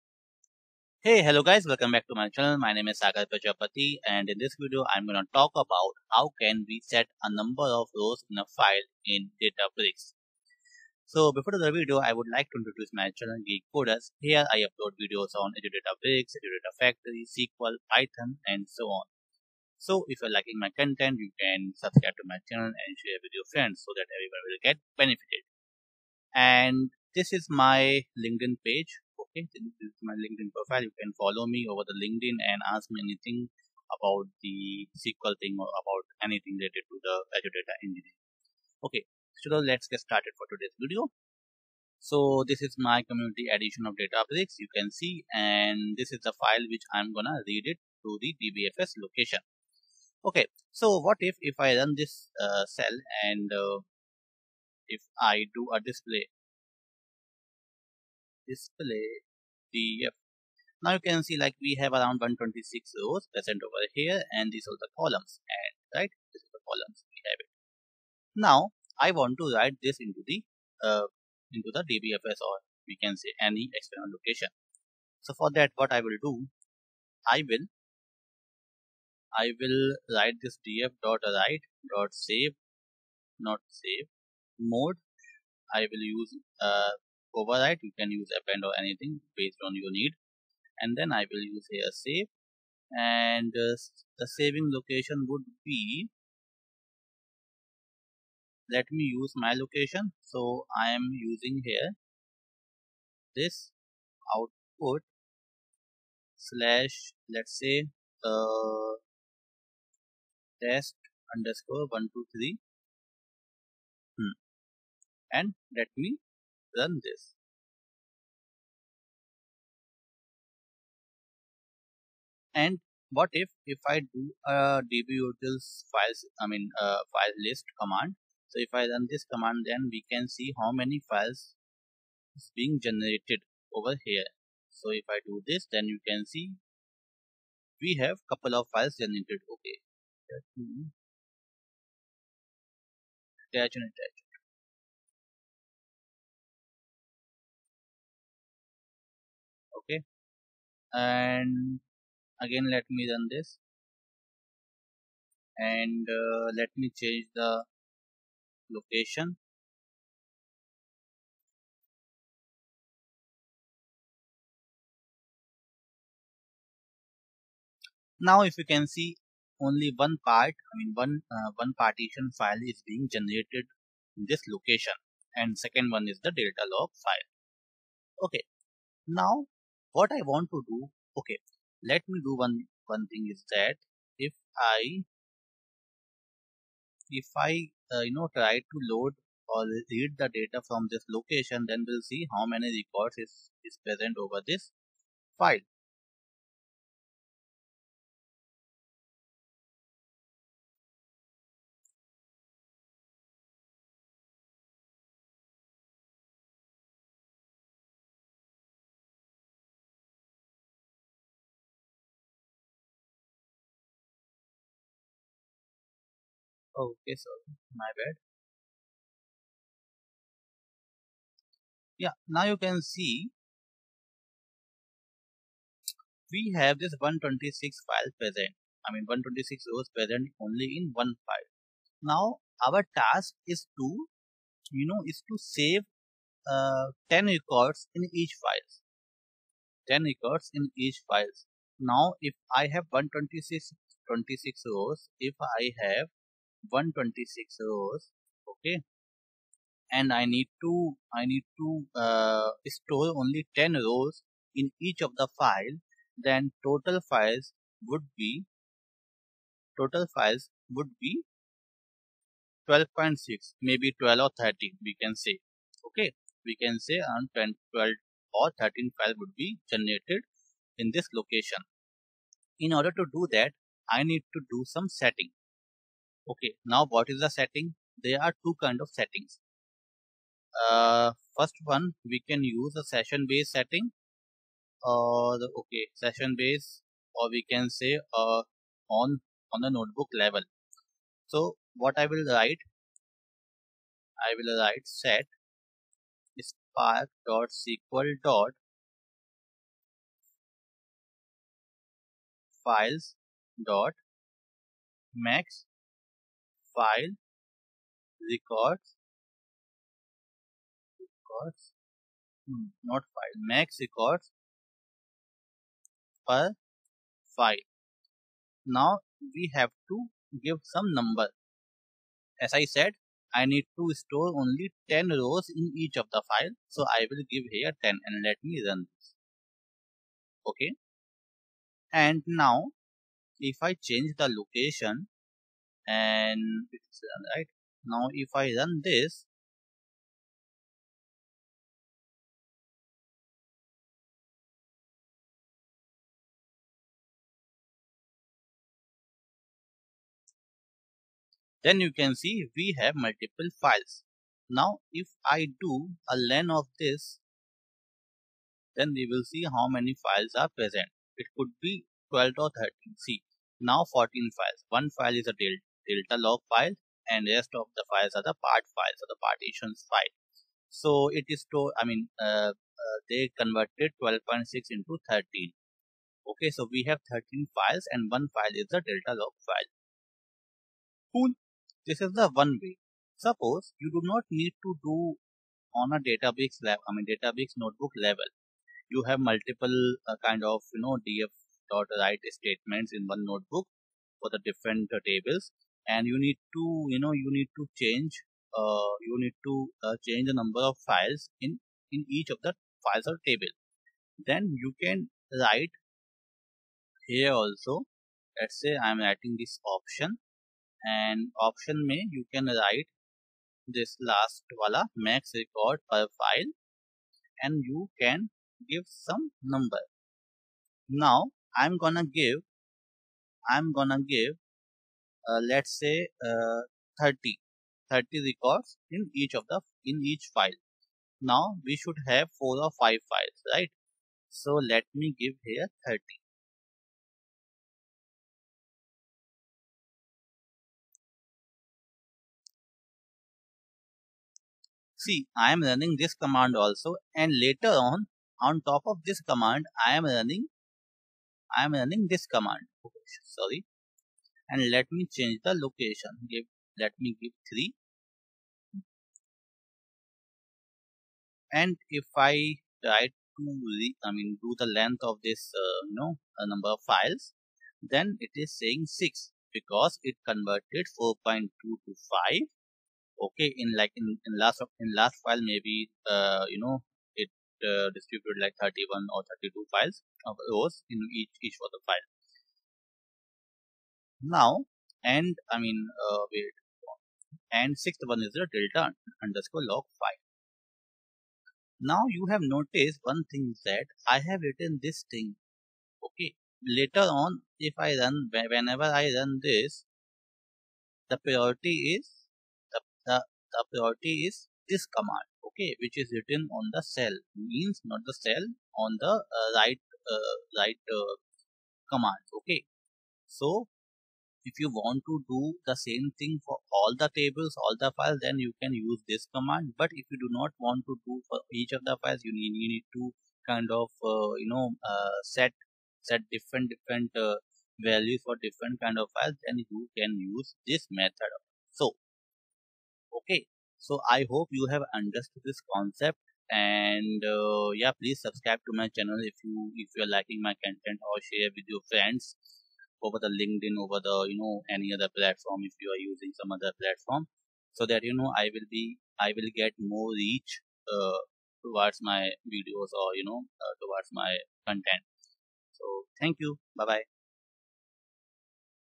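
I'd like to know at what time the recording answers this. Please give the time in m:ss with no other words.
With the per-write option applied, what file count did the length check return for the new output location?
7:48.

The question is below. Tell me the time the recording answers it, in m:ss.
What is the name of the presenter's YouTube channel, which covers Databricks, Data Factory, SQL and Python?
0:13.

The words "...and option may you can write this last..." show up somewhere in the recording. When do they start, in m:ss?
6:50.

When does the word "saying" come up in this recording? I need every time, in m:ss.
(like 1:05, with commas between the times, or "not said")
7:48.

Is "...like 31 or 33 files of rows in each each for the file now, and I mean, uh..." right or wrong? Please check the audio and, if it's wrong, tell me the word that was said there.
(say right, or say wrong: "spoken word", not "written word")
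wrong: "32", not "33".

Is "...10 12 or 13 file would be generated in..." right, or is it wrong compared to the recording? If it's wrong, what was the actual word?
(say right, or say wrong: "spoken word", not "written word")
right.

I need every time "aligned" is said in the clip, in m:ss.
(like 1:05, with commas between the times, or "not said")
not said.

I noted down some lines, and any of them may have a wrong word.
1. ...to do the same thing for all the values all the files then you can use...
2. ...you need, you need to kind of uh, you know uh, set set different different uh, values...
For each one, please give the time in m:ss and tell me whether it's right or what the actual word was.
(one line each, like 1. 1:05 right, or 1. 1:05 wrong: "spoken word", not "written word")
1. 8:35 wrong: "tables", not "values"
2. 8:42 right.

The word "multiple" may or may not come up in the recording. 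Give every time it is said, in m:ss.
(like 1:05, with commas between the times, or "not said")
5:52, 6:29.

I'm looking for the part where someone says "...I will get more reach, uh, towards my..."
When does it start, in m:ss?
9:09.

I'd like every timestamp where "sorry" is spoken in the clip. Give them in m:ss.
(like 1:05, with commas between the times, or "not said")
3:37, 7:33.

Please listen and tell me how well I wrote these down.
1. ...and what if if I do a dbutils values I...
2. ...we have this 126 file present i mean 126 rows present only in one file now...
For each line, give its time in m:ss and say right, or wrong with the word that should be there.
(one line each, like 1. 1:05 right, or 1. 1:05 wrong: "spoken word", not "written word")
1. 2:02 wrong: "files", not "values"
2. 3:46 right.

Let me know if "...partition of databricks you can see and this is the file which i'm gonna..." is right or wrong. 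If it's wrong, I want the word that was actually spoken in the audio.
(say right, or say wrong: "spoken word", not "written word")
wrong: "edition", not "partition".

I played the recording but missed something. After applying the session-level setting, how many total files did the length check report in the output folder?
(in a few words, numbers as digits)
14.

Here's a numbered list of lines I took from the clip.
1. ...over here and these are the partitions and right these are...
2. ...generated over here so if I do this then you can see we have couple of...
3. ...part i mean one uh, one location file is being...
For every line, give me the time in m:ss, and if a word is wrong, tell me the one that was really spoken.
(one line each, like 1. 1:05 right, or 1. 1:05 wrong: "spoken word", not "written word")
1. 1:03 wrong: "columns", not "partitions"
2. 2:12 right
3. 2:50 wrong: "partition", not "location".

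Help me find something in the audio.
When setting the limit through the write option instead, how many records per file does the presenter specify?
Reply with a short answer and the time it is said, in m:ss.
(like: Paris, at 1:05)
30, at 7:07.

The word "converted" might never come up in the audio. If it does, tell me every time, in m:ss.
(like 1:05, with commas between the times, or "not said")
6:13, 7:50.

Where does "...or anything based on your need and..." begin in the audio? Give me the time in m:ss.
1:28.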